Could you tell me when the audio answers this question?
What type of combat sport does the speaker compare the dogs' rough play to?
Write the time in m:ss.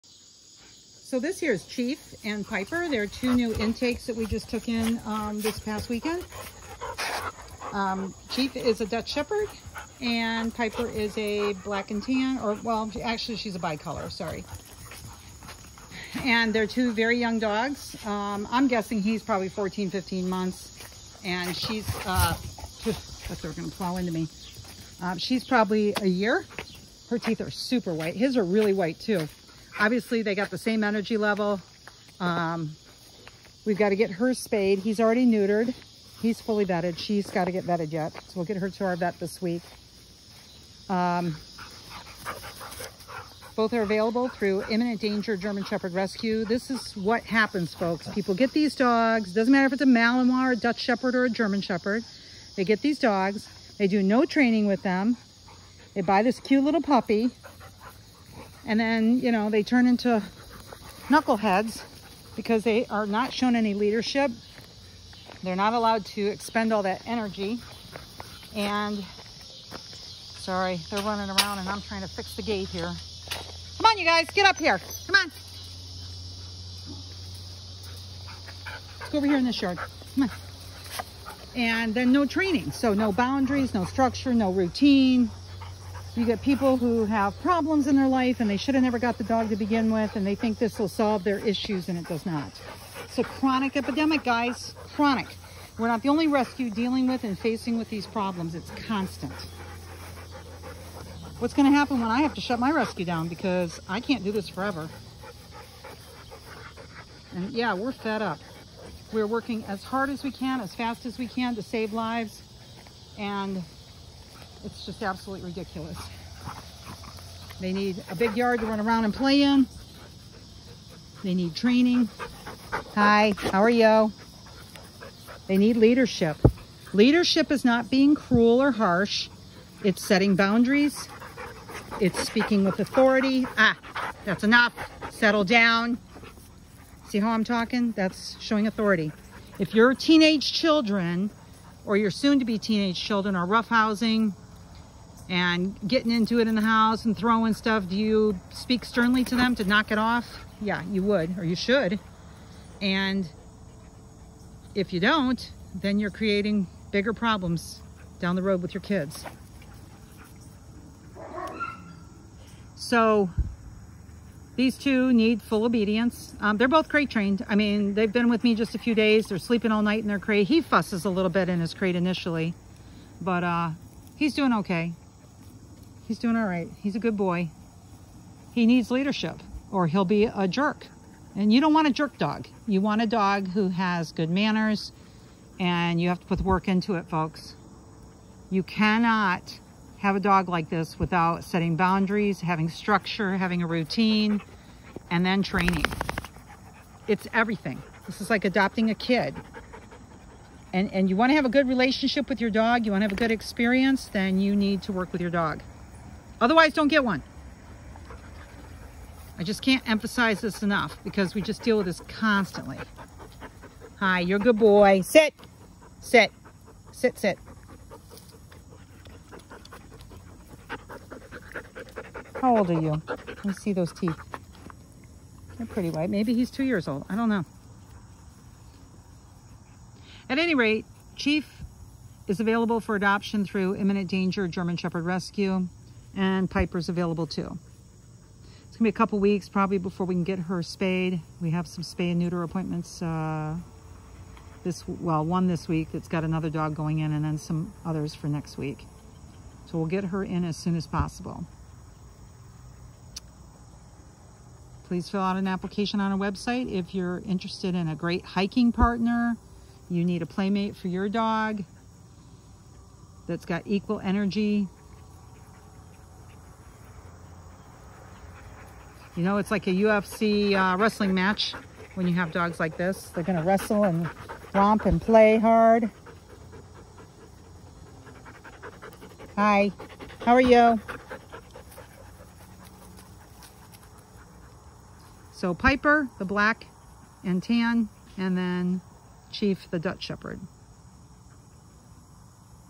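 4:29.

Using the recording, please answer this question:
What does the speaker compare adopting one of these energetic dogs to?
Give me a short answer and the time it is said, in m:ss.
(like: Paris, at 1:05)
A kid, at 3:18.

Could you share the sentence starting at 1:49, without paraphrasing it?
We're working as hard as we can, as fast as we can to save lives.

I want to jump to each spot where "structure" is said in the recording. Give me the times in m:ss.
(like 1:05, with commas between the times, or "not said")
1:23, 3:12.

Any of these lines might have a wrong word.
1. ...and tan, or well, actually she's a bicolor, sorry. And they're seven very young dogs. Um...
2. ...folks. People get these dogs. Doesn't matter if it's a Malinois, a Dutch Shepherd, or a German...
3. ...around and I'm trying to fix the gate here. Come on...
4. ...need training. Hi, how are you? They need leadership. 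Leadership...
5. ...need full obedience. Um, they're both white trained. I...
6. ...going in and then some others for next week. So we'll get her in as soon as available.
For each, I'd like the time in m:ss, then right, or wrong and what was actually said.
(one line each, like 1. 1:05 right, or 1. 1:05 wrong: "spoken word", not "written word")
1. 0:11 wrong: "two", not "seven"
2. 0:47 right
3. 1:11 right
4. 2:01 right
5. 2:45 wrong: "crate", not "white"
6. 4:06 wrong: "possible", not "available".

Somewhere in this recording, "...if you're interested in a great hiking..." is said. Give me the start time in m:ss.
4:16.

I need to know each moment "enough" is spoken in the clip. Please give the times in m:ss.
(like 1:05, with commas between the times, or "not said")
2:14, 3:30.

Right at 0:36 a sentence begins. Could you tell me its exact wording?
She's got to get vetted yet.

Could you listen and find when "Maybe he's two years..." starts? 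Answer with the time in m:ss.
3:46.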